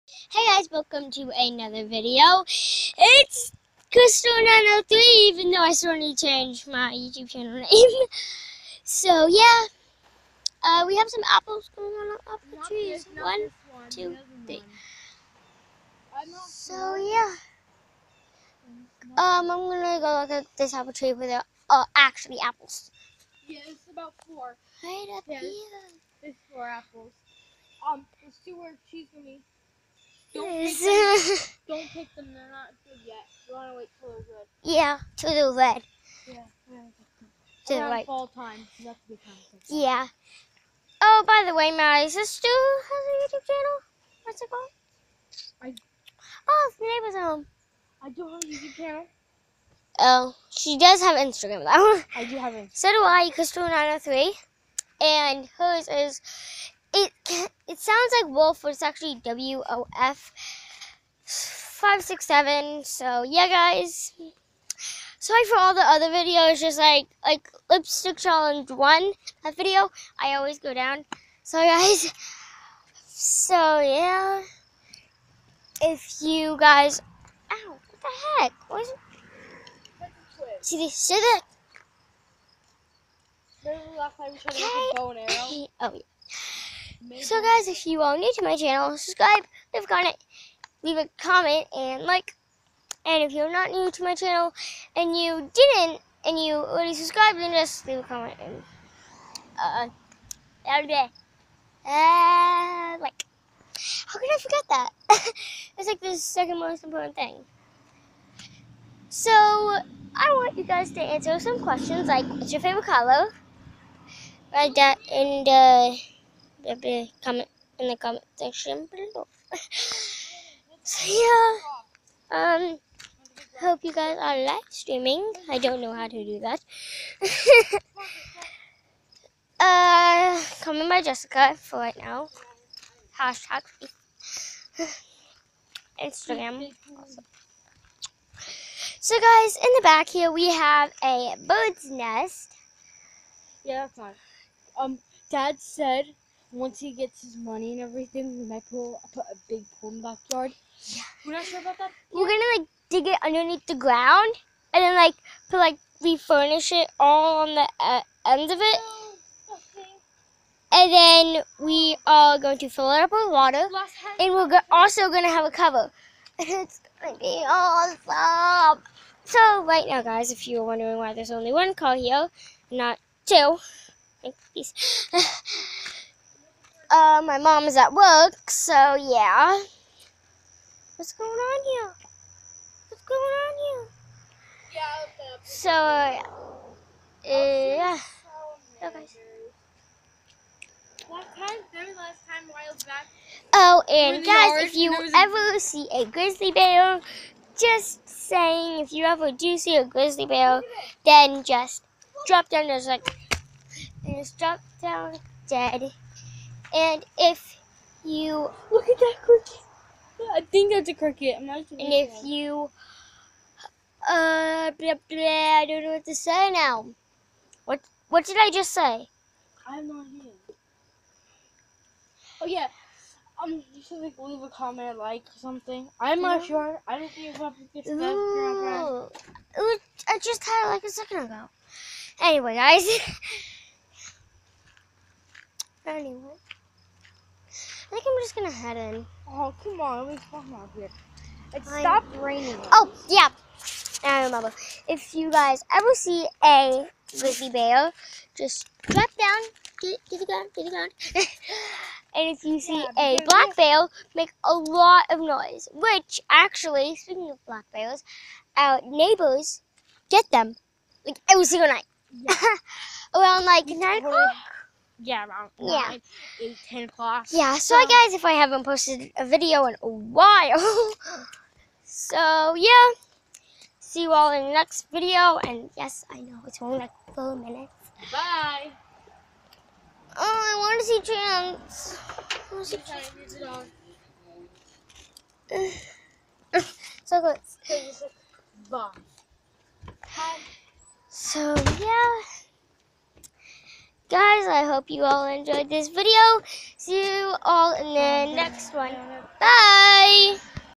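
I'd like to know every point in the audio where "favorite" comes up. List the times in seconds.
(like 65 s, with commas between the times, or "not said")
112 s.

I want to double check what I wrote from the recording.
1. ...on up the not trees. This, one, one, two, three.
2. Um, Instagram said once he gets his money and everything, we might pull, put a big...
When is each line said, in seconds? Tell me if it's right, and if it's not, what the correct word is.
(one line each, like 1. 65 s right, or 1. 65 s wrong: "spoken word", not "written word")
1. 11 s right
2. 144 s wrong: "Dad", not "Instagram".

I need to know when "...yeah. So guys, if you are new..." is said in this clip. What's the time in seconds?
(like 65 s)
85 s.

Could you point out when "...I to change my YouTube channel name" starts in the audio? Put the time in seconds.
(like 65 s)
5 s.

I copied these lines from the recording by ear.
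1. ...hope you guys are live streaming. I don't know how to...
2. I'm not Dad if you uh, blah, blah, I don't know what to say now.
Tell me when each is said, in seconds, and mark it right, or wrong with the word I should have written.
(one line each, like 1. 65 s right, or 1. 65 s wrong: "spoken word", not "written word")
1. 123 s right
2. 211 s wrong: "And", not "Dad".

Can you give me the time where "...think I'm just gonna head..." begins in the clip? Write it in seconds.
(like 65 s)
237 s.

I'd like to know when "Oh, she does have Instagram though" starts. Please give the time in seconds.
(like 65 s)
49 s.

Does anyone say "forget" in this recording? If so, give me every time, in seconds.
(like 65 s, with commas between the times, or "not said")
104 s.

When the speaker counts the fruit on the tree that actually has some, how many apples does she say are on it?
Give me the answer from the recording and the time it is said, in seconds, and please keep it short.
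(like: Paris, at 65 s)
4, at 26 s.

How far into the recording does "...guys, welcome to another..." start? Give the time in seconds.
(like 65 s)
0 s.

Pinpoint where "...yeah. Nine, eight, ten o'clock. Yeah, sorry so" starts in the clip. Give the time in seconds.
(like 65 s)
265 s.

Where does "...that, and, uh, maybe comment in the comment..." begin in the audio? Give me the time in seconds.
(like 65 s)
114 s.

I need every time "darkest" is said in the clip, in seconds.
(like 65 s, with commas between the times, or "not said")
not said.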